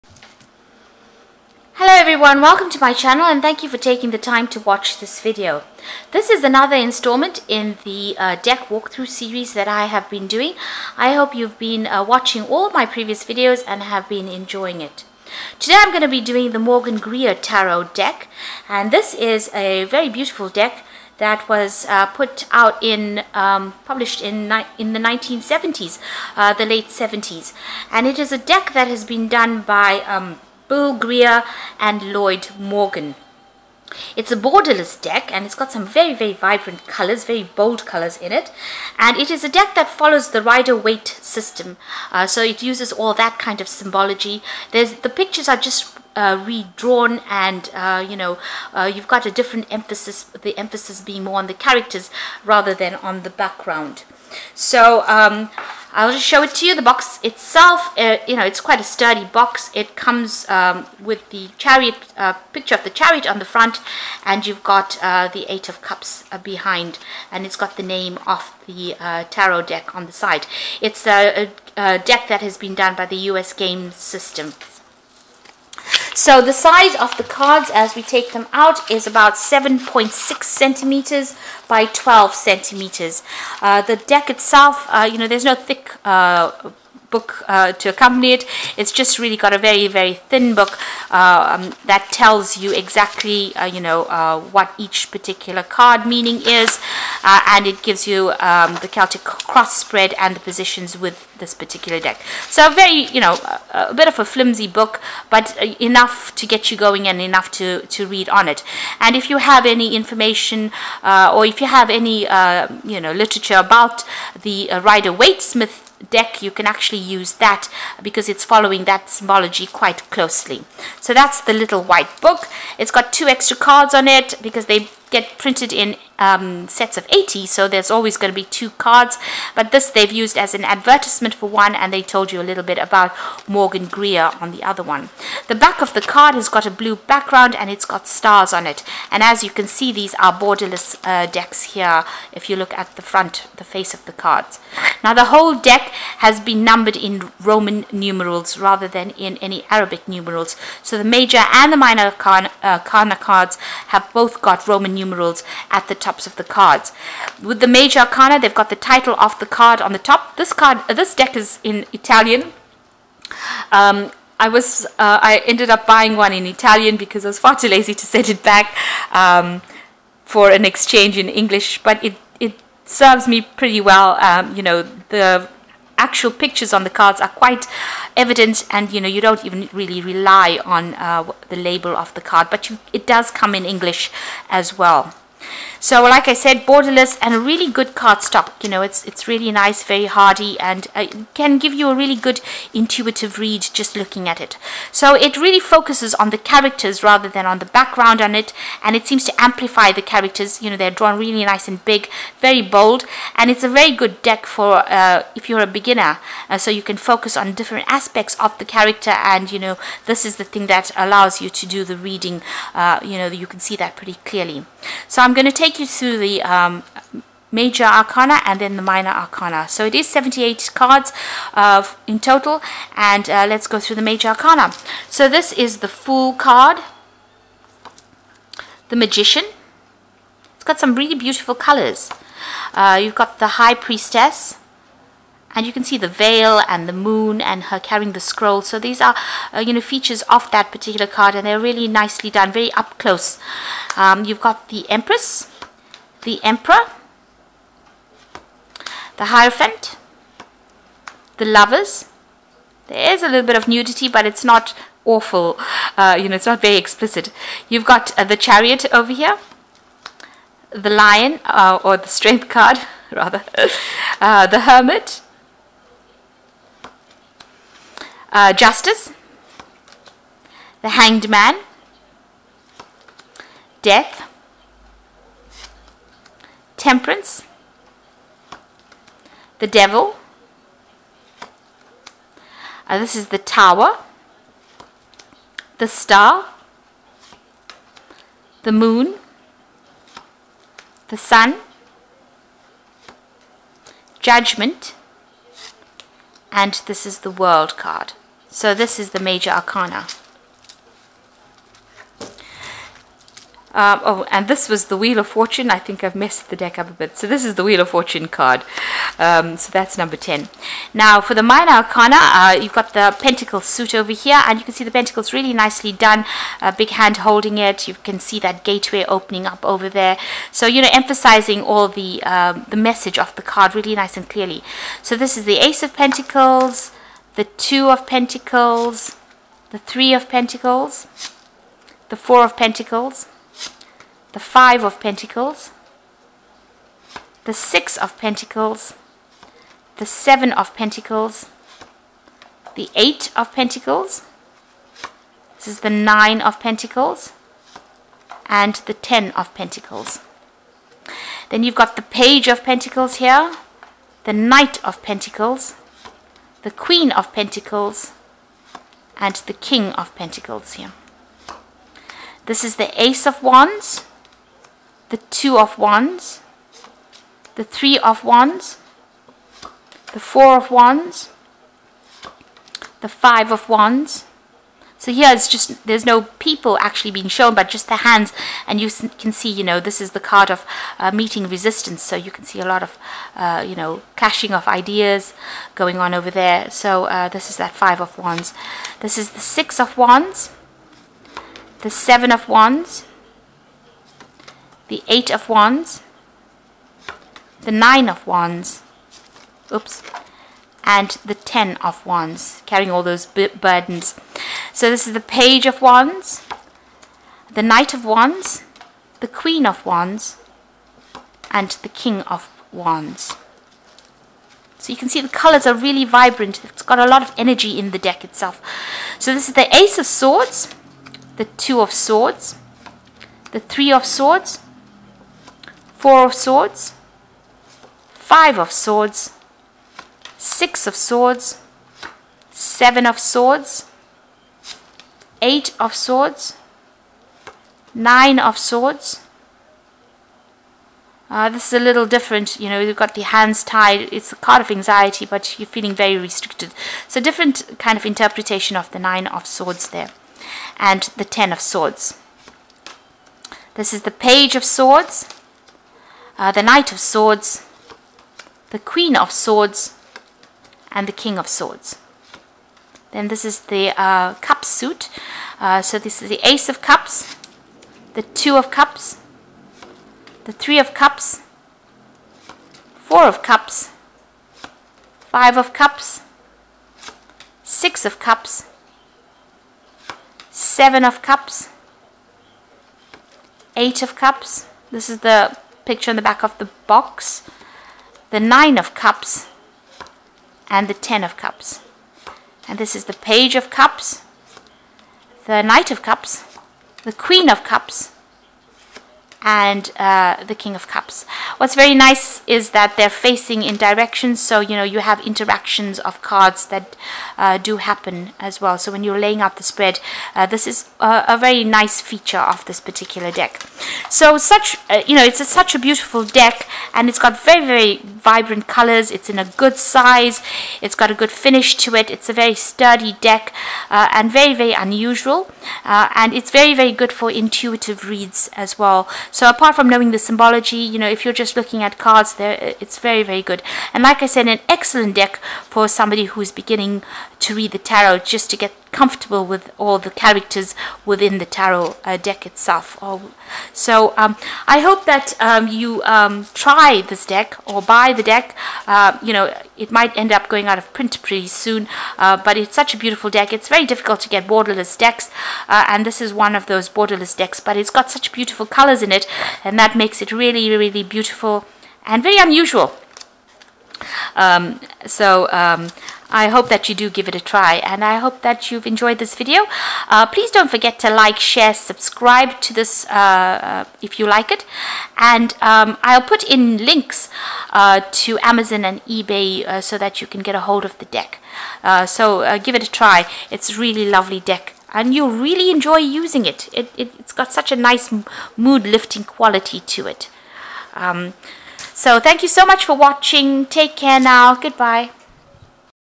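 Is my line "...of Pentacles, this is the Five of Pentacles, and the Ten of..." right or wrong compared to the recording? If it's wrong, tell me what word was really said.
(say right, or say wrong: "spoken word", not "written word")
wrong: "Nine", not "Five".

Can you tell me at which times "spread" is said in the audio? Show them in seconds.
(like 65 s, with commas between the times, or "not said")
99 s, 509 s.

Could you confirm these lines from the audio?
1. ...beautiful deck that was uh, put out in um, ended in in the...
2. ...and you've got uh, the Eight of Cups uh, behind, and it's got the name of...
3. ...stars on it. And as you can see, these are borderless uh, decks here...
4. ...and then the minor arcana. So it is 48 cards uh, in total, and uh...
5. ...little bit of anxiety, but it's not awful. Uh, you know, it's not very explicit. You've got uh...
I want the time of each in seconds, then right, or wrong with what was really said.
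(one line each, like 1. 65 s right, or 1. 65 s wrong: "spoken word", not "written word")
1. 20 s wrong: "published", not "ended"
2. 64 s right
3. 138 s right
4. 218 s wrong: "78", not "48"
5. 253 s wrong: "nudity", not "anxiety".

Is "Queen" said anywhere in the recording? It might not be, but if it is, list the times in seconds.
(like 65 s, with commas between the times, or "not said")
356 s, 409 s, 458 s, 497 s.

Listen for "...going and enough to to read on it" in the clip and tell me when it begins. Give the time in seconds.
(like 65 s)
106 s.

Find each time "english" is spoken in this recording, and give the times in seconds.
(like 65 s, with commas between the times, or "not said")
171 s, 183 s.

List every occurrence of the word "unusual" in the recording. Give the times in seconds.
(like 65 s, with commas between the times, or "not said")
524 s, 562 s.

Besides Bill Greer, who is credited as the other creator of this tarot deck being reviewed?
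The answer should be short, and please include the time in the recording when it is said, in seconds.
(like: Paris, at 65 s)
Lloyd Morgan, at 32 s.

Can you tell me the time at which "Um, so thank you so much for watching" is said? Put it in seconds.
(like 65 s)
590 s.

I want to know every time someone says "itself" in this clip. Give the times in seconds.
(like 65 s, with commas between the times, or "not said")
57 s, 84 s, 418 s, 542 s.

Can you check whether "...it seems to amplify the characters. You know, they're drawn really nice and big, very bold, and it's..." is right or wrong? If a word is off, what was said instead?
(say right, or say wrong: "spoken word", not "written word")
right.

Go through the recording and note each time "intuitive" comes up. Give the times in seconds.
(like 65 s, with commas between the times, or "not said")
192 s, 527 s.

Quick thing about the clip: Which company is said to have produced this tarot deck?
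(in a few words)
U.S. Game System.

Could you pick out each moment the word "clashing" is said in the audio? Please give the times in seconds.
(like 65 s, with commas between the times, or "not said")
384 s.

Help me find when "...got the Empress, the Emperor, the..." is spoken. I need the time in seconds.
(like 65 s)
244 s.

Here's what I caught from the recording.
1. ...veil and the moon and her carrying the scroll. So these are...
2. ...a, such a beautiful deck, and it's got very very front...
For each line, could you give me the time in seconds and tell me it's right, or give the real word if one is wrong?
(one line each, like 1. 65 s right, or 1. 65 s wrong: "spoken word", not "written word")
1. 236 s right
2. 515 s wrong: "vibrant", not "front".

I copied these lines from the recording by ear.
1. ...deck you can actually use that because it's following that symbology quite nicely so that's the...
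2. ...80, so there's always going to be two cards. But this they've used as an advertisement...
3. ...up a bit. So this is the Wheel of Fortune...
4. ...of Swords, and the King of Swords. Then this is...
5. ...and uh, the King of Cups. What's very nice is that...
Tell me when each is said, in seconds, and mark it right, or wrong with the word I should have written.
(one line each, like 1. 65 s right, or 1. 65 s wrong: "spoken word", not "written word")
1. 116 s wrong: "closely", not "nicely"
2. 127 s right
3. 306 s right
4. 459 s right
5. 499 s right.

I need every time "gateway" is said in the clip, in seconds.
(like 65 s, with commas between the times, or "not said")
318 s.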